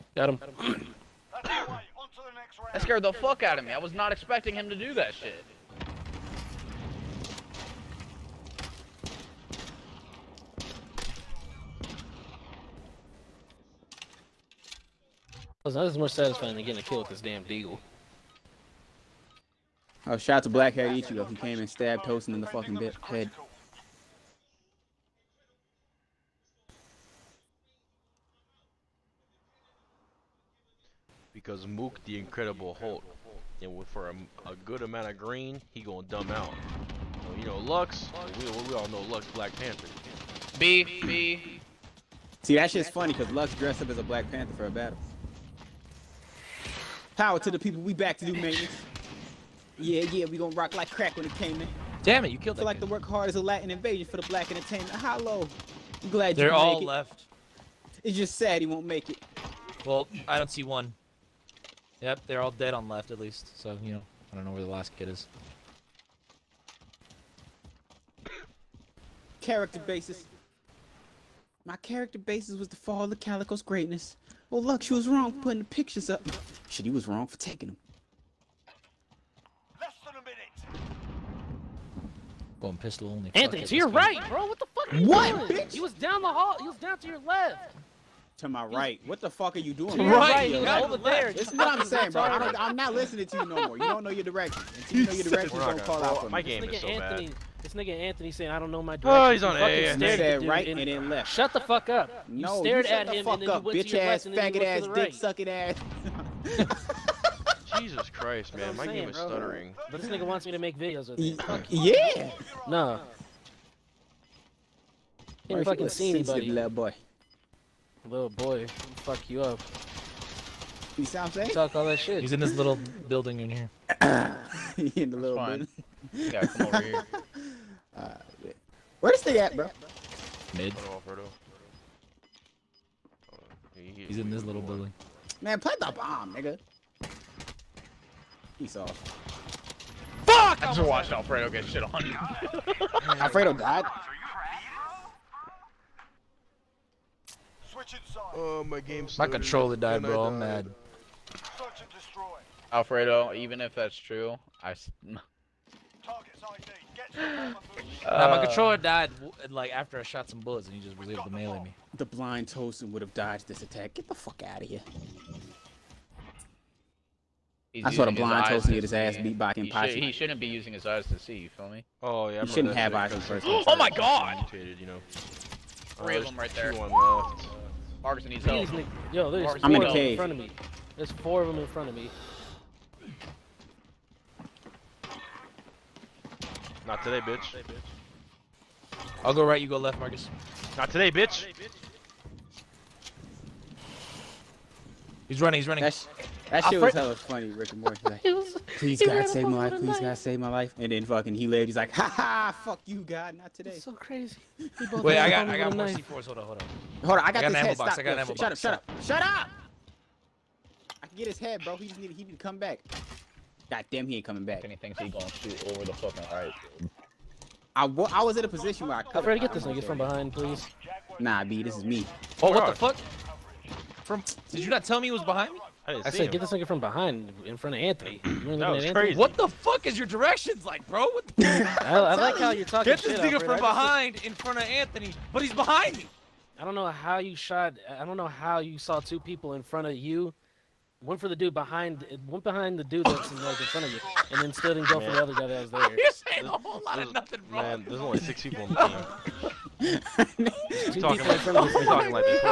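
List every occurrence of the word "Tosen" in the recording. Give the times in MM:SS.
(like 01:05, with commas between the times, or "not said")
00:22, 02:42, 02:48.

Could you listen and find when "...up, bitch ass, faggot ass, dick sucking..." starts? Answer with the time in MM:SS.
01:43.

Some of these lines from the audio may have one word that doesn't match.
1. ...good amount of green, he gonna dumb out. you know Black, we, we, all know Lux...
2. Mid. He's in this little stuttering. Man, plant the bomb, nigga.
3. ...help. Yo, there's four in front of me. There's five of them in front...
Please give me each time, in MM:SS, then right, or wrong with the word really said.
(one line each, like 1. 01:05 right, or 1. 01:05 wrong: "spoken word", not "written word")
1. 00:34 wrong: "Lux", not "Black"
2. 02:10 wrong: "building", not "stuttering"
3. 02:58 wrong: "four", not "five".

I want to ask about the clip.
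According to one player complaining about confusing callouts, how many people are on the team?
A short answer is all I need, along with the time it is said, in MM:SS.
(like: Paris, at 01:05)
6, at 04:08.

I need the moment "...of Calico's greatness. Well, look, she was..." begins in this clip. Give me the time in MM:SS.
01:13.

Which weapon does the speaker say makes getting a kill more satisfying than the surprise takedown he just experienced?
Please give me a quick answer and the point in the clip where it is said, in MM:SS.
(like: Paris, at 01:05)
Deagle, at 00:17.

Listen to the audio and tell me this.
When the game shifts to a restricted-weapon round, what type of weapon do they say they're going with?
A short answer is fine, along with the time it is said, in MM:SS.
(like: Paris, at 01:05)
Pistol only, at 01:22.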